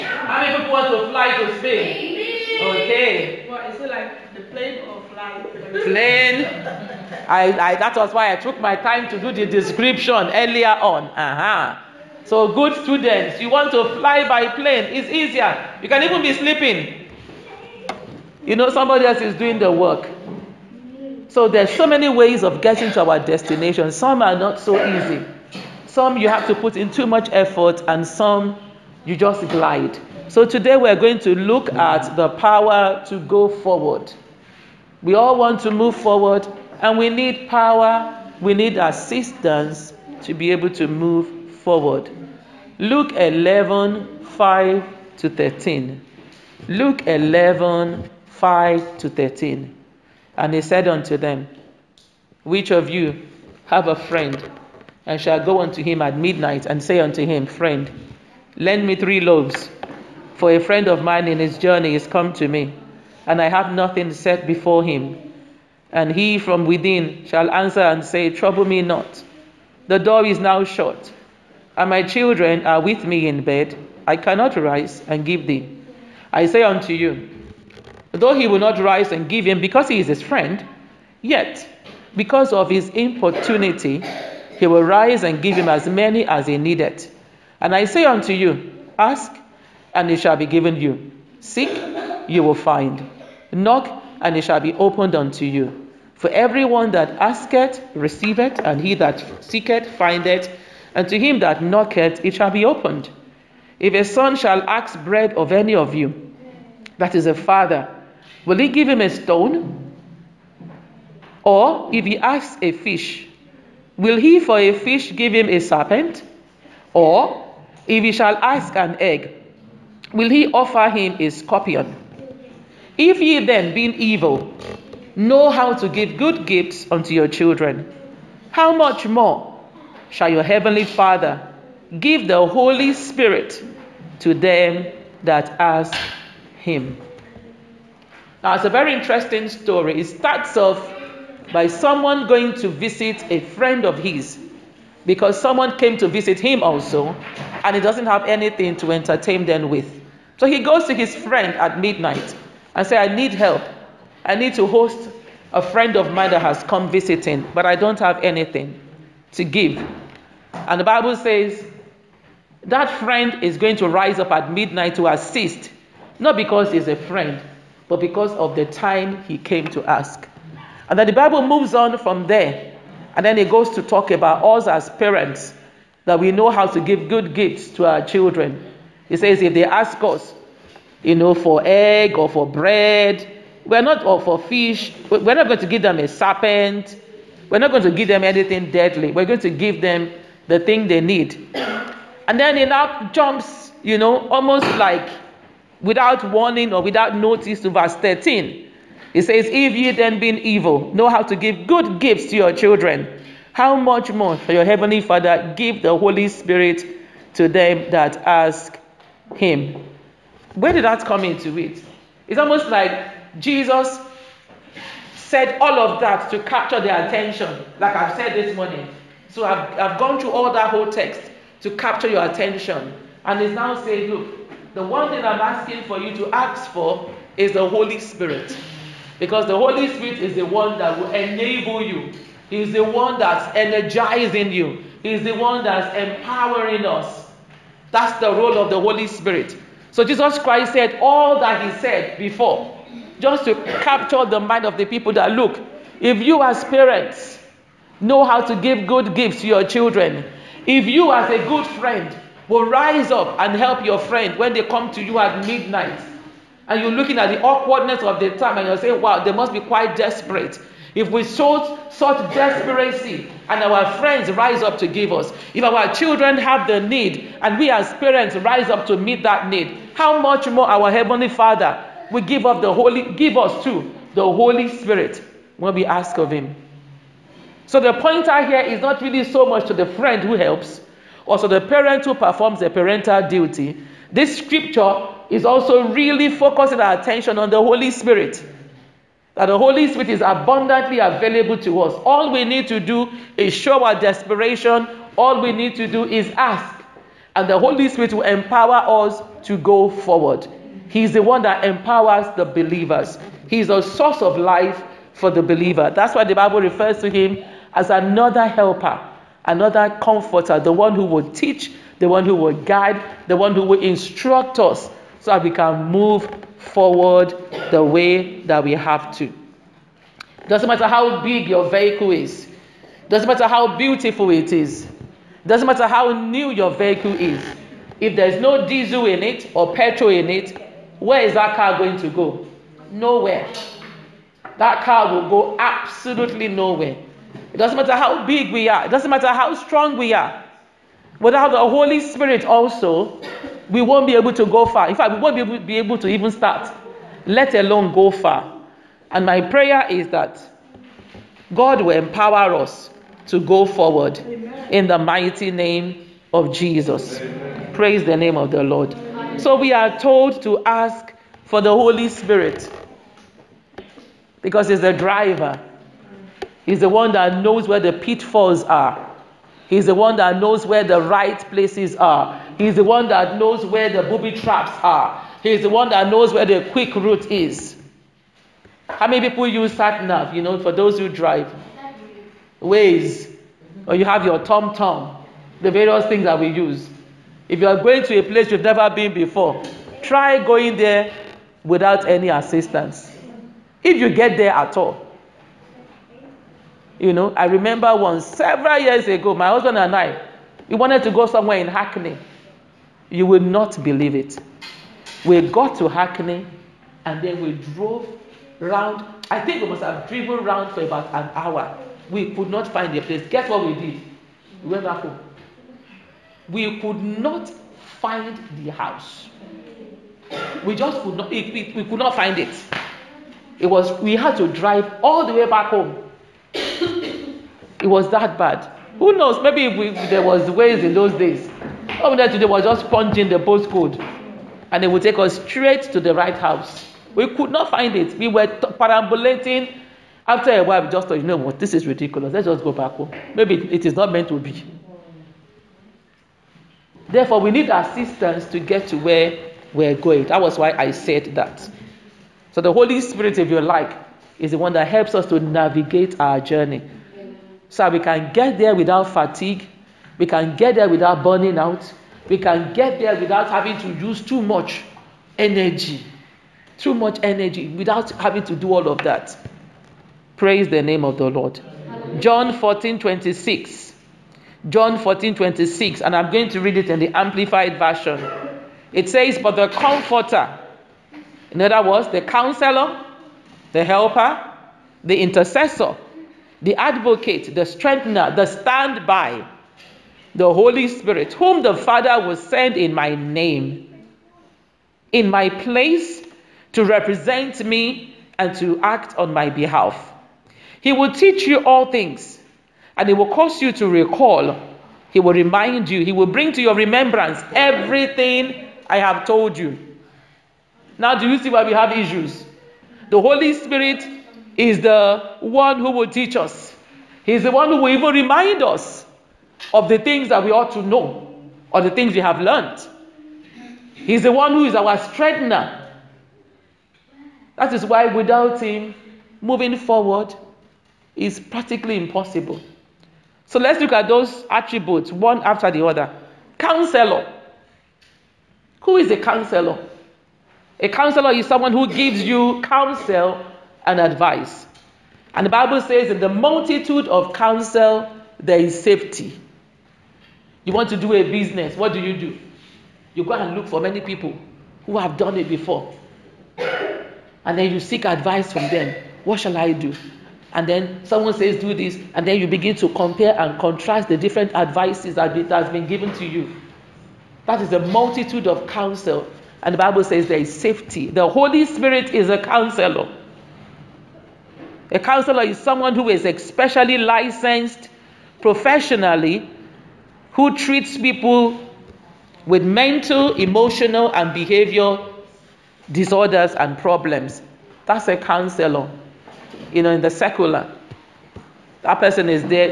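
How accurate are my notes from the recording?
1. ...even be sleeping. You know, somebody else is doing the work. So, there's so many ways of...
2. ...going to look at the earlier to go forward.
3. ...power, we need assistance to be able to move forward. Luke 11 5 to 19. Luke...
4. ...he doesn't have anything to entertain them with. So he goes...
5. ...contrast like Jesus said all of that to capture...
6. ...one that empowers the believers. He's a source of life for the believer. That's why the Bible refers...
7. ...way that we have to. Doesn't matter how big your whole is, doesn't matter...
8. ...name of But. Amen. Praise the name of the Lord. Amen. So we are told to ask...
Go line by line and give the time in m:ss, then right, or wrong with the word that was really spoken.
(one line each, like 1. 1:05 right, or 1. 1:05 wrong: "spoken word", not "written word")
1. 0:16 right
2. 0:30 wrong: "power", not "earlier"
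3. 0:37 wrong: "13", not "19"
4. 2:27 right
5. 3:32 wrong: "almost", not "contrast"
6. 5:01 right
7. 5:17 wrong: "vehicle", not "whole"
8. 5:55 wrong: "Jesus", not "But".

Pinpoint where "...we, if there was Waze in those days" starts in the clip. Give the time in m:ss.
7:09.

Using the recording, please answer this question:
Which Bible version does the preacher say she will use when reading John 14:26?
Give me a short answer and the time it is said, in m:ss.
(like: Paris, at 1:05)
Amplified Version, at 7:57.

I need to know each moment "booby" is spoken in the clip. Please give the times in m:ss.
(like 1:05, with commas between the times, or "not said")
6:14.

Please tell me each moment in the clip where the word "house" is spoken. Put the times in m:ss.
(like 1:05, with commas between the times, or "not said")
6:58, 7:16.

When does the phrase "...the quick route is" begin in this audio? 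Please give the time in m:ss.
6:16.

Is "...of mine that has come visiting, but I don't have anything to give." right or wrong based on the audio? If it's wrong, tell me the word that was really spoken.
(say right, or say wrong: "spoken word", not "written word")
right.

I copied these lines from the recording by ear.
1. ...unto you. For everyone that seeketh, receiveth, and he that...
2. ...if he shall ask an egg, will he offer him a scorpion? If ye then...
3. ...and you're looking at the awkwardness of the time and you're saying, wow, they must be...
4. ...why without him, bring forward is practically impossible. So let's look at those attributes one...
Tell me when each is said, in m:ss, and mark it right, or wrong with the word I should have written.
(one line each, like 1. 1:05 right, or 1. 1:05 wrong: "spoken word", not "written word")
1. 1:35 wrong: "asketh", not "seeketh"
2. 1:57 right
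3. 4:16 right
4. 8:47 wrong: "moving", not "bring".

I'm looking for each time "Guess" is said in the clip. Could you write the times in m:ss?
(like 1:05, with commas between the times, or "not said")
6:53.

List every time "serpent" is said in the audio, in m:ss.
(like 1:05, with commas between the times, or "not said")
1:55, 3:06.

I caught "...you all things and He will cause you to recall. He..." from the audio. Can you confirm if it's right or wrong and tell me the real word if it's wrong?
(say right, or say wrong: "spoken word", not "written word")
right.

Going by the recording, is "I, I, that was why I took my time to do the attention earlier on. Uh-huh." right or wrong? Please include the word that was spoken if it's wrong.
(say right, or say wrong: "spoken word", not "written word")
wrong: "description", not "attention".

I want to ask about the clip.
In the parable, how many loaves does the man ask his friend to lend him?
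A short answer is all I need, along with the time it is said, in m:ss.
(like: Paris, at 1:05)
3, at 0:58.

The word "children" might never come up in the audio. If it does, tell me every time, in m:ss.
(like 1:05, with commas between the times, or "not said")
1:12, 2:07, 2:58, 3:22, 4:09, 4:25.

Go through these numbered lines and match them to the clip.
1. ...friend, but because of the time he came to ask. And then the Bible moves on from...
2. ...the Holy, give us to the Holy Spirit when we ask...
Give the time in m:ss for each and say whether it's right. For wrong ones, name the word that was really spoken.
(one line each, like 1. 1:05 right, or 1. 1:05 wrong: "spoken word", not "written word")
1. 2:46 right
2. 4:32 right.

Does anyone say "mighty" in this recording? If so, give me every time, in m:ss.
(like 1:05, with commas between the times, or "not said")
5:54.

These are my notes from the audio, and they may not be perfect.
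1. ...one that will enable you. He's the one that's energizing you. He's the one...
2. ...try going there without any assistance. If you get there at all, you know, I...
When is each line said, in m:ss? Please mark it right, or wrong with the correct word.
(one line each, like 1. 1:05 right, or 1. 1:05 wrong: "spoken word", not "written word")
1. 3:50 right
2. 6:30 right.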